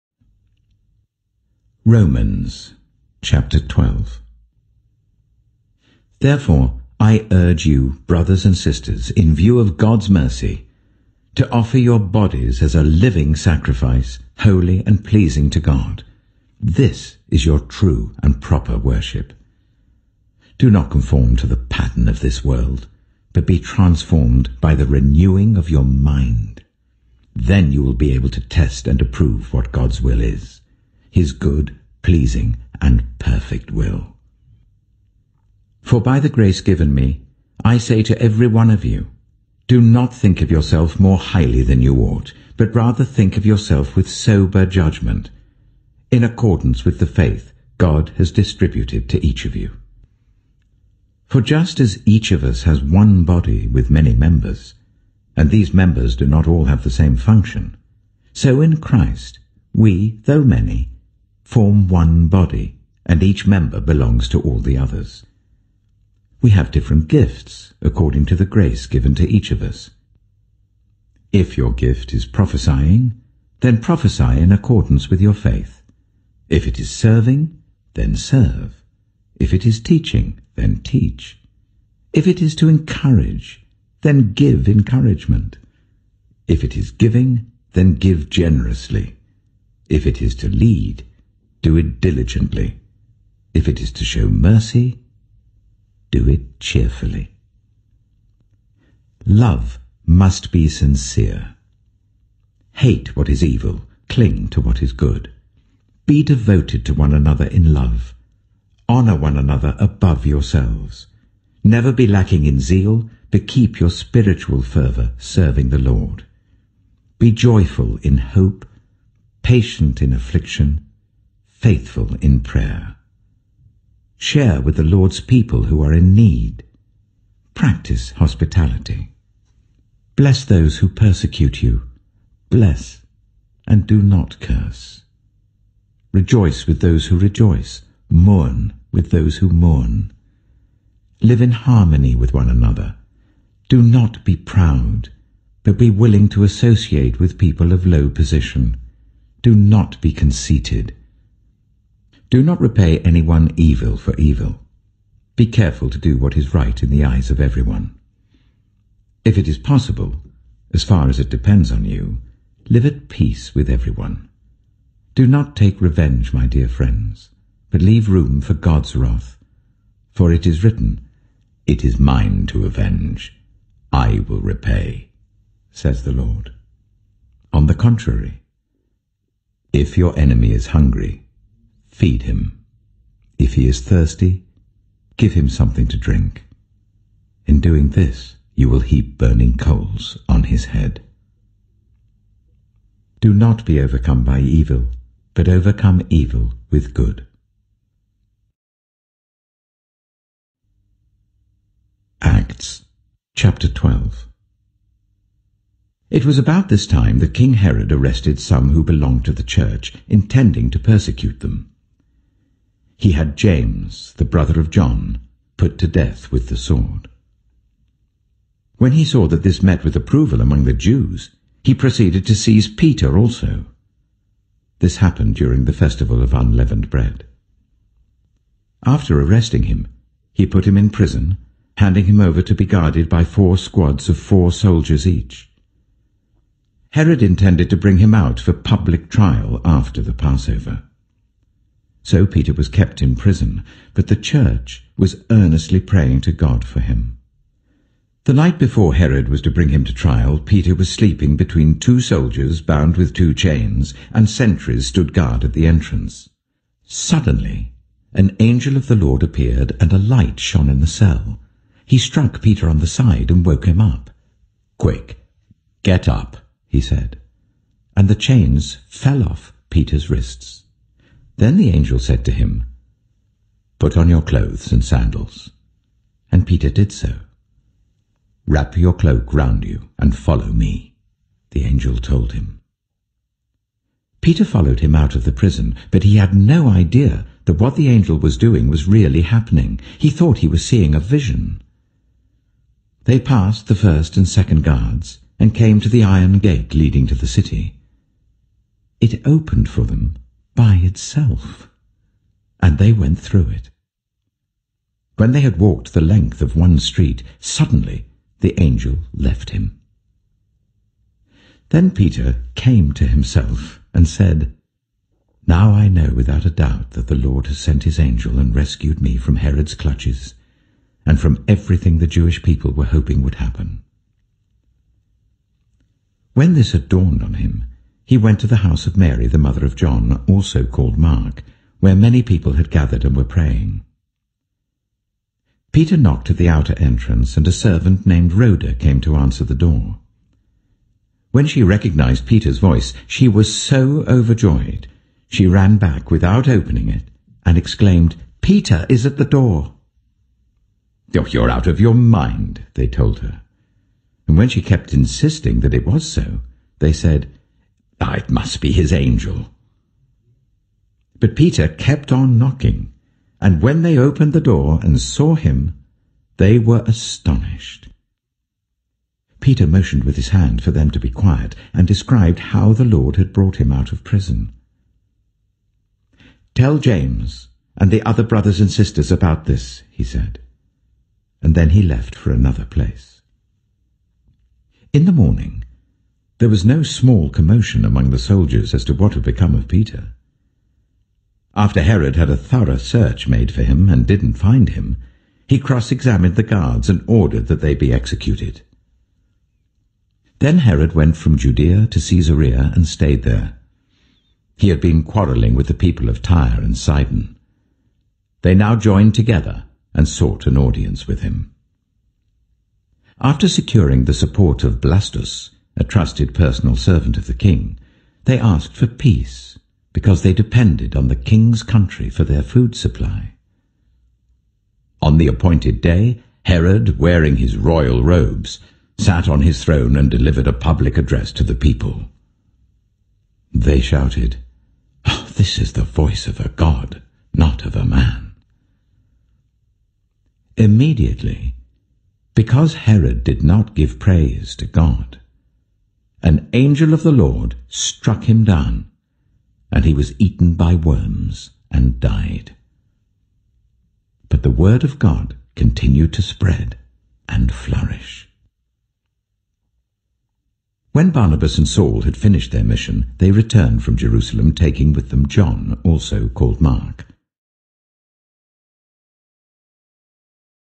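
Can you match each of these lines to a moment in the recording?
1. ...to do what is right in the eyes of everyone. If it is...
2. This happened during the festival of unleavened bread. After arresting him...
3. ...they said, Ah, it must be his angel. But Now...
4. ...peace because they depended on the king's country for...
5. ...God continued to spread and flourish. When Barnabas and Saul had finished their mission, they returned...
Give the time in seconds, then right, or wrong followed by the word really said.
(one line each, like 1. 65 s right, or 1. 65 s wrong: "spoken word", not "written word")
1. 155 s right
2. 224 s right
3. 356 s wrong: "Peter", not "Now"
4. 418 s right
5. 454 s right.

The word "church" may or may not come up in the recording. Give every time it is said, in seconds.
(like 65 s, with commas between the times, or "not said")
209 s, 244 s.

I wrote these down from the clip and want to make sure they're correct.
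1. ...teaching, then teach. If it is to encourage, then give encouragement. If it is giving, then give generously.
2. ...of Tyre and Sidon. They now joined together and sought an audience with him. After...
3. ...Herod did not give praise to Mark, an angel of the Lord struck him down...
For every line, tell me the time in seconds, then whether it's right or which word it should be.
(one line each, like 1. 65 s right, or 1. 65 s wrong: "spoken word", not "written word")
1. 79 s right
2. 406 s right
3. 442 s wrong: "God", not "Mark".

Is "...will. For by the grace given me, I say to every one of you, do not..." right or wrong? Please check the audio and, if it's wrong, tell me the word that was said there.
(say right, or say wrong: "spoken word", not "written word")
right.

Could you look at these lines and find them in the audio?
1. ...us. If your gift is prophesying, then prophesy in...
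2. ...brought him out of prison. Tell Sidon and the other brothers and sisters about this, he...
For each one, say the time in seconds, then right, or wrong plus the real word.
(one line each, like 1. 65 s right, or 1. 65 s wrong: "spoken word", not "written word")
1. 69 s right
2. 373 s wrong: "James", not "Sidon".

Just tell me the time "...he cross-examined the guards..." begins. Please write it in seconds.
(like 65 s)
395 s.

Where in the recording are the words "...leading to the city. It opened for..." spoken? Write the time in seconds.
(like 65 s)
296 s.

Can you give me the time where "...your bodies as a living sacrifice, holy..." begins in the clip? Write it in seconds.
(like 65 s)
11 s.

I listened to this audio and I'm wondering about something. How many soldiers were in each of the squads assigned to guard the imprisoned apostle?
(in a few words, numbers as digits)
4.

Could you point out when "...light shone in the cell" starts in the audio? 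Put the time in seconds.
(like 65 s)
259 s.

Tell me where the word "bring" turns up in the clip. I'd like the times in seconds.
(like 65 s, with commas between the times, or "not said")
237 s, 249 s.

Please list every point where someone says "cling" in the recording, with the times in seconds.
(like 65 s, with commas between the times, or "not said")
104 s.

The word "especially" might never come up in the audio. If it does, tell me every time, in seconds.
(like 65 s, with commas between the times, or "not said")
not said.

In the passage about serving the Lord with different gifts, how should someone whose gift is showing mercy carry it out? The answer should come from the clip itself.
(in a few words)
Cheerfully.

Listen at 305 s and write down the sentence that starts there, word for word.
When they had walked the length of one street, suddenly the angel left him.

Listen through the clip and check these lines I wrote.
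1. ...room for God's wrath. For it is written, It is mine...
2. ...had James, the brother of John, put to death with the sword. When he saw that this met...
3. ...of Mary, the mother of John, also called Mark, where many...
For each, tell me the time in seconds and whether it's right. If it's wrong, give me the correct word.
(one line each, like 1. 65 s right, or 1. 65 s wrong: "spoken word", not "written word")
1. 168 s right
2. 213 s right
3. 328 s right.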